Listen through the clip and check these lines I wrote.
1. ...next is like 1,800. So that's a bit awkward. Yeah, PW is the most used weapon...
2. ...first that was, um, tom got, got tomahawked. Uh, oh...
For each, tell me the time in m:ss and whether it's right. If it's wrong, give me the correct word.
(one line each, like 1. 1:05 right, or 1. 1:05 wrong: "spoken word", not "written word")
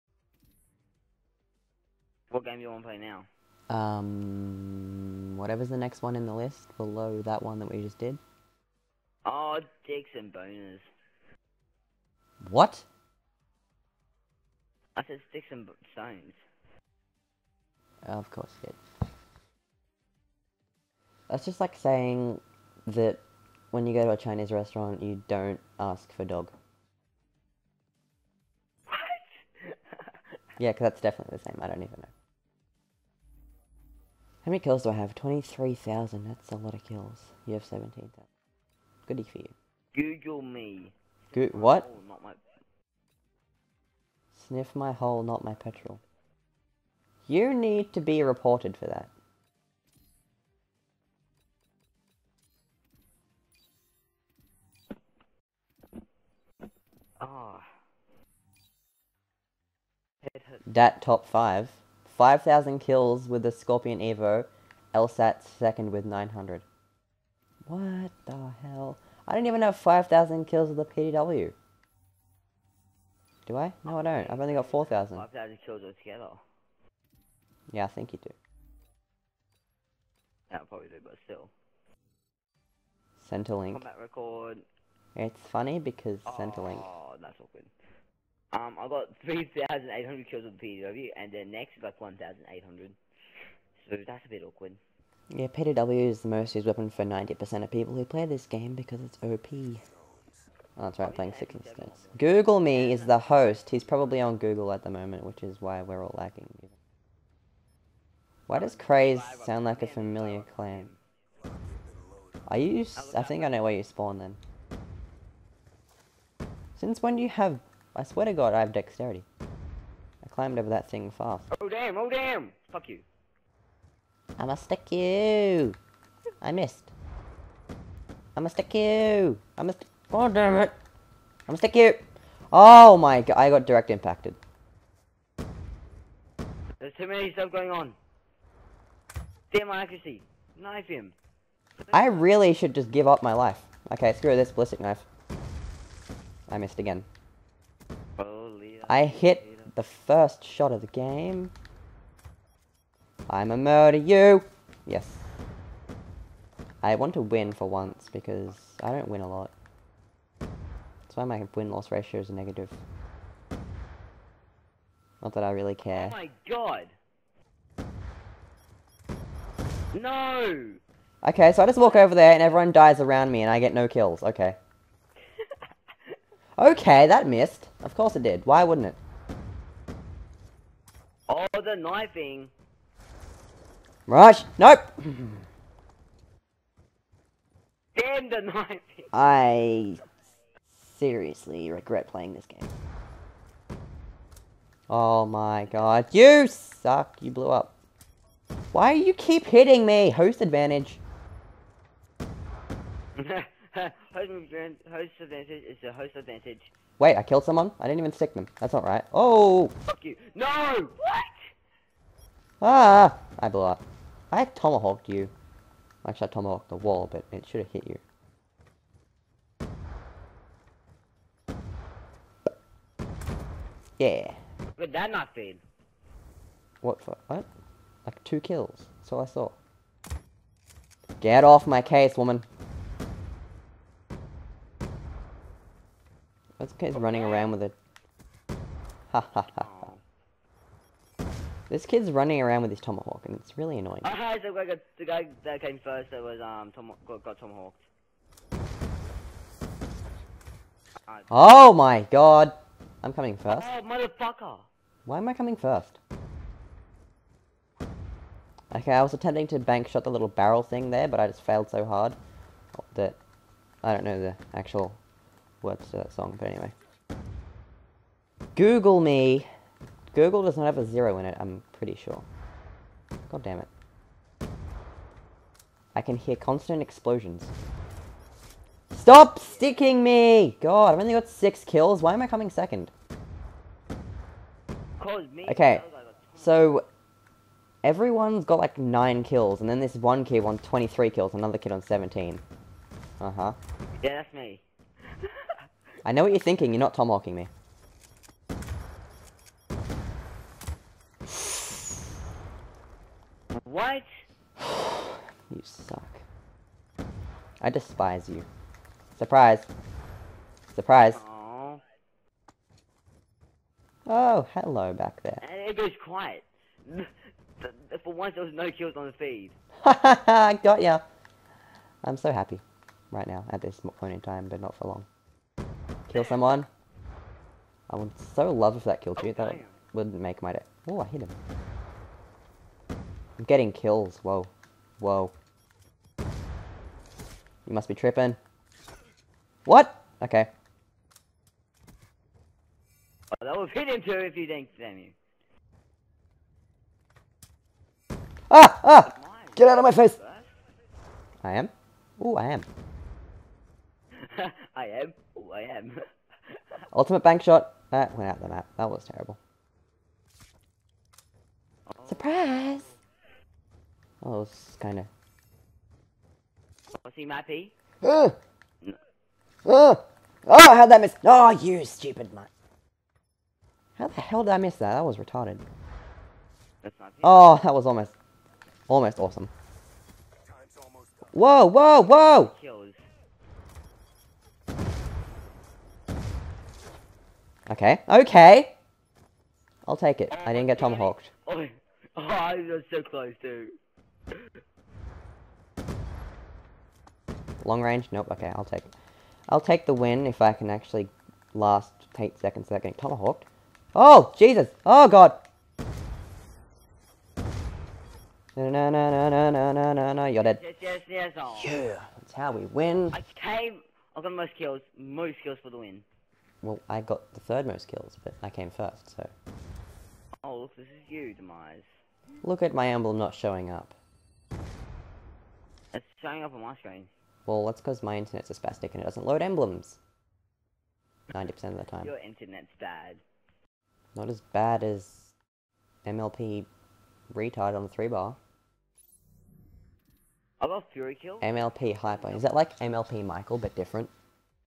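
1. 1:31 right
2. 4:05 right.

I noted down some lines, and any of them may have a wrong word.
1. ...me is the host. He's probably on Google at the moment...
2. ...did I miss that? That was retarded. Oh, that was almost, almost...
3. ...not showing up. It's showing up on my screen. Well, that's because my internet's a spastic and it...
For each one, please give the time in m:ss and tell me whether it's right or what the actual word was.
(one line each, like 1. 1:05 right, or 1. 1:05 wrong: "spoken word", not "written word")
1. 1:42 right
2. 6:14 right
3. 7:03 right.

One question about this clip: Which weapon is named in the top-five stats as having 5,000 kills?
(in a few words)
Skorpion Evo.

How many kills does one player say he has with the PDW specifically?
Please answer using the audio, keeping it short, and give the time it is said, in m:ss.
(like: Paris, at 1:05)
4,000, at 1:14.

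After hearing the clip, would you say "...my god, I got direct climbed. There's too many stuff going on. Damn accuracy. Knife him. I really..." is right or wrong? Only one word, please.
wrong.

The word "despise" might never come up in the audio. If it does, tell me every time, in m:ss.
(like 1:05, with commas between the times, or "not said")
5:07.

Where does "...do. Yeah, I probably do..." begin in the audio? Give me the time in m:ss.
1:18.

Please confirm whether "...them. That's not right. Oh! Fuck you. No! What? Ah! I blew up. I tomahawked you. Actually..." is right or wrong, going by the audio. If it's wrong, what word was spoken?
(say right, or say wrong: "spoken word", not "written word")
right.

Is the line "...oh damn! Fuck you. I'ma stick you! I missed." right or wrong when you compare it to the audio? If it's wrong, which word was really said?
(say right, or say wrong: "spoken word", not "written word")
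right.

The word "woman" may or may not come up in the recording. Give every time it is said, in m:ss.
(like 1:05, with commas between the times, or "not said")
3:52.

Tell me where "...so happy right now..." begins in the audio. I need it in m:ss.
5:22.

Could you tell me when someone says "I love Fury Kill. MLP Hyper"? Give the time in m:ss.
7:20.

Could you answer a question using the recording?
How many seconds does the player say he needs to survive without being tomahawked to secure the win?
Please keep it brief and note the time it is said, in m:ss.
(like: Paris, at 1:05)
8, at 6:42.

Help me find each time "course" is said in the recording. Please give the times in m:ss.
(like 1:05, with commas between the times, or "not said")
0:18, 2:57.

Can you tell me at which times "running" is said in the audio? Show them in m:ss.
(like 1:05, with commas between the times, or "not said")
3:56, 4:02.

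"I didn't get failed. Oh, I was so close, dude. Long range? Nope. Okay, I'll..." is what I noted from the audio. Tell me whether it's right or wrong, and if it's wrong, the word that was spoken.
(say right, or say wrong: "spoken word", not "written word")
wrong: "tomahawked", not "failed".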